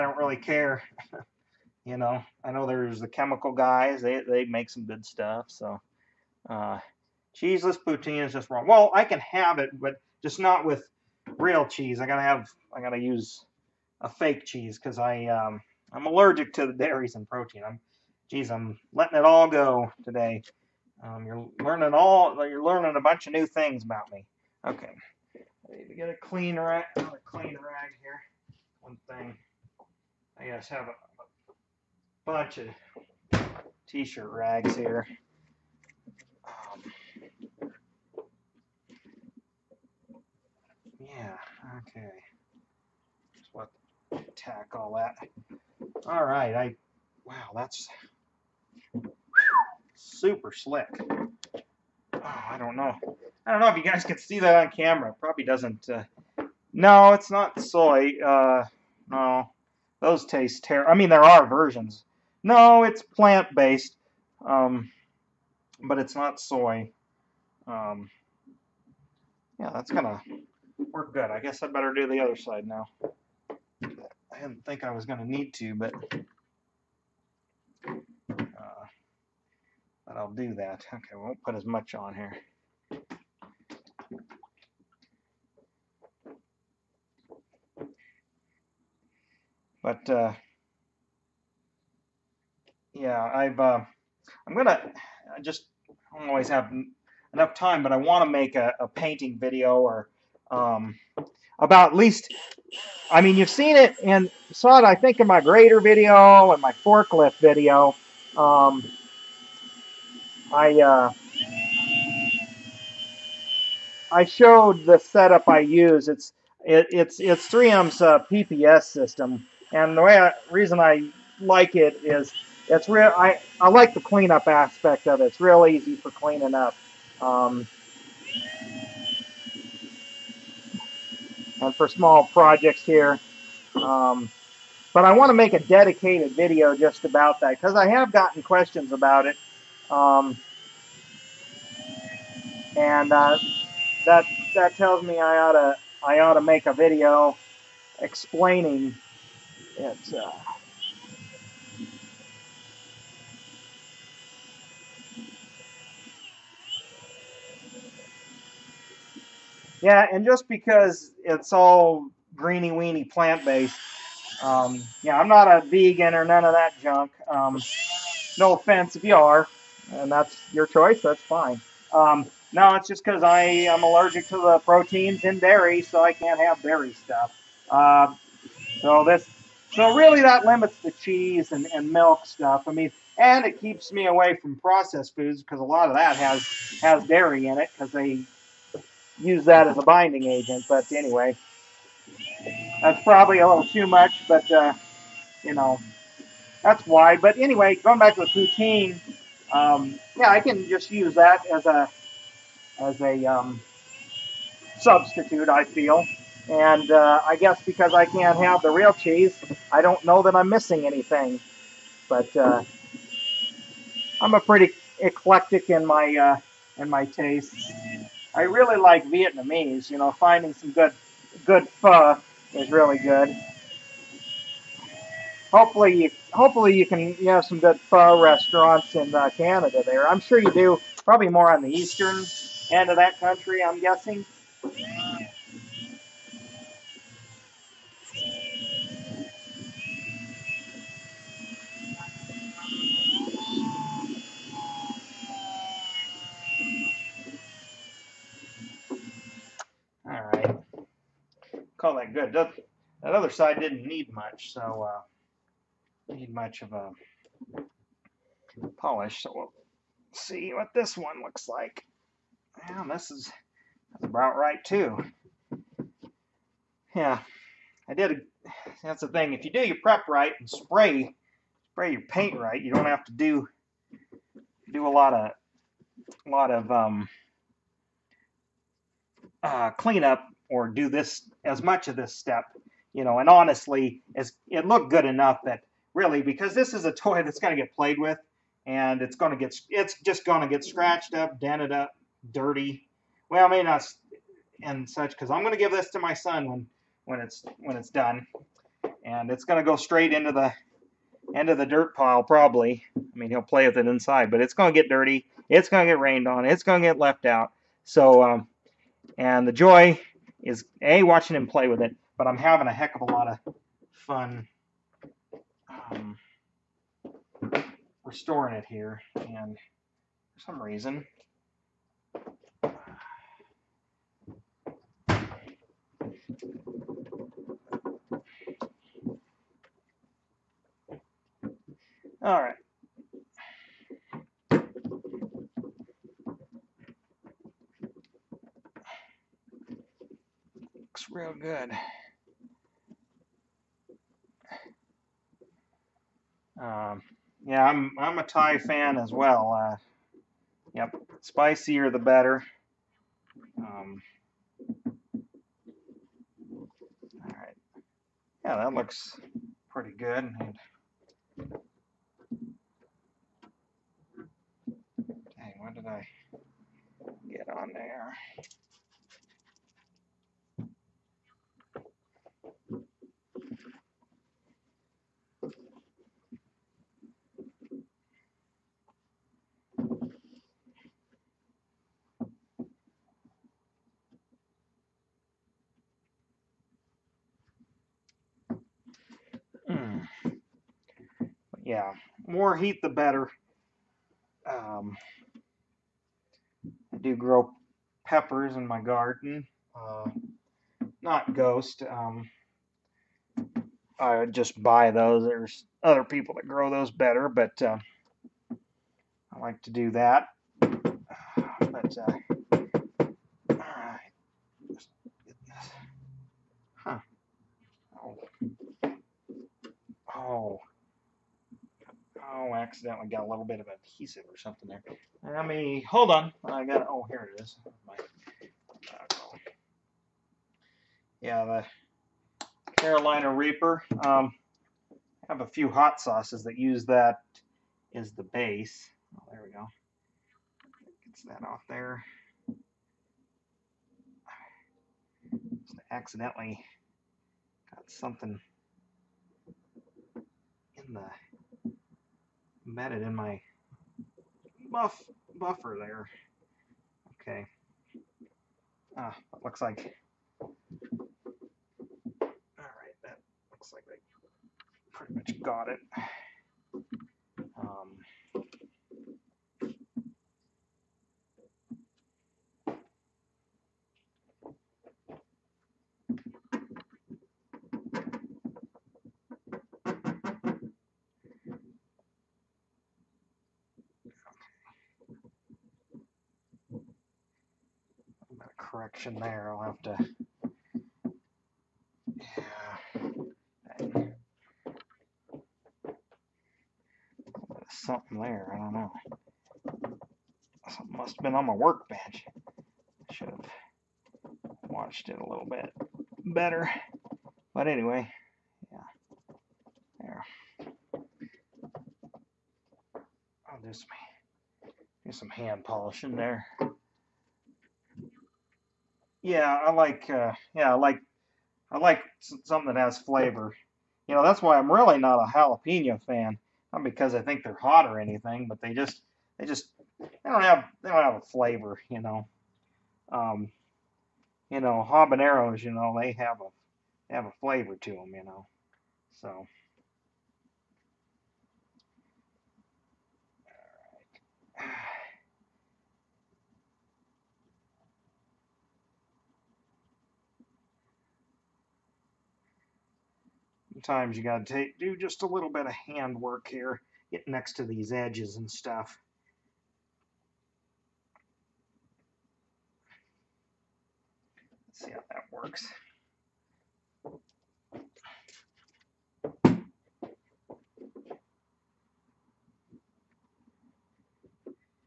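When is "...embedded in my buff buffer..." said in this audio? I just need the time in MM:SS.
07:32.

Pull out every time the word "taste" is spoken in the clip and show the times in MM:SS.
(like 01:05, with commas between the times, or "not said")
01:00, 03:37.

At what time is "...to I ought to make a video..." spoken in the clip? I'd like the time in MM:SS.
02:25.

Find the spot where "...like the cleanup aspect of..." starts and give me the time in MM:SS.
02:03.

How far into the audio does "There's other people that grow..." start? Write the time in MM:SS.
06:45.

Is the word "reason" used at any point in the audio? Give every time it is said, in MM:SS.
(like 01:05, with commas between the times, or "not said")
02:00, 05:20.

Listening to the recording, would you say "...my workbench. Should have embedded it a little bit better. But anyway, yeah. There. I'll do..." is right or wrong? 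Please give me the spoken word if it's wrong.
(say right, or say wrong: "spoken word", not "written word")
wrong: "watched", not "embedded".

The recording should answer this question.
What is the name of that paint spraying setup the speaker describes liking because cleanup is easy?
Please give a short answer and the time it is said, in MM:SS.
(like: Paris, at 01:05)
PPS system, at 01:58.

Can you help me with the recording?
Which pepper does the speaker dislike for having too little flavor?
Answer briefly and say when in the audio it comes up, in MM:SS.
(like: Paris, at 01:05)
jalapeno, at 08:45.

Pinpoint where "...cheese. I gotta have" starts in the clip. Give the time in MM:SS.
00:11.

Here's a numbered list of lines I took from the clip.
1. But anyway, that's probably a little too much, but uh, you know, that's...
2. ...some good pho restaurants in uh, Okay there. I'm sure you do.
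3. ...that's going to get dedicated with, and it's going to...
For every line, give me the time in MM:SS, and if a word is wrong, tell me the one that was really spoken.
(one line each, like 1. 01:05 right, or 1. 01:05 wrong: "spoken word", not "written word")
1. 03:10 right
2. 03:47 wrong: "Canada", not "Okay"
3. 04:47 wrong: "played", not "dedicated".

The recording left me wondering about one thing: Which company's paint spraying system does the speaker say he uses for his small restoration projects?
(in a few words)
3M.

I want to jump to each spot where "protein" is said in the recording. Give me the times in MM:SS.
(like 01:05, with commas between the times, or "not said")
00:17, 02:54.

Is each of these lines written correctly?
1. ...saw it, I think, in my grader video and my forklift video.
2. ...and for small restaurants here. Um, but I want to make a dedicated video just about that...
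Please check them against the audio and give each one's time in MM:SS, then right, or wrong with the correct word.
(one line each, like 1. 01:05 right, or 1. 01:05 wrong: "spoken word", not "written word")
1. 01:44 right
2. 02:11 wrong: "projects", not "restaurants".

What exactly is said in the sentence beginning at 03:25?
I feel, and uh, I guess because I can't have the real cheese, I don't know that I'm missing anything.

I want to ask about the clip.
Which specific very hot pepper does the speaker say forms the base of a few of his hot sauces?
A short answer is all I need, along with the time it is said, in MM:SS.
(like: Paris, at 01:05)
Carolina Reaper, at 07:12.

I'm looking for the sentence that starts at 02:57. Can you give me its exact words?
Uh, so this, so really, that limits the cheese and, and milk stuff.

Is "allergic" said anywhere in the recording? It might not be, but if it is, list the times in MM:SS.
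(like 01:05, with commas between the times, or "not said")
00:16, 02:53.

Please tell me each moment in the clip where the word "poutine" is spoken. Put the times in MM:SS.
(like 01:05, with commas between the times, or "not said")
00:07, 03:18.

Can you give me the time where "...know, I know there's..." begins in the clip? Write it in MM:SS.
00:01.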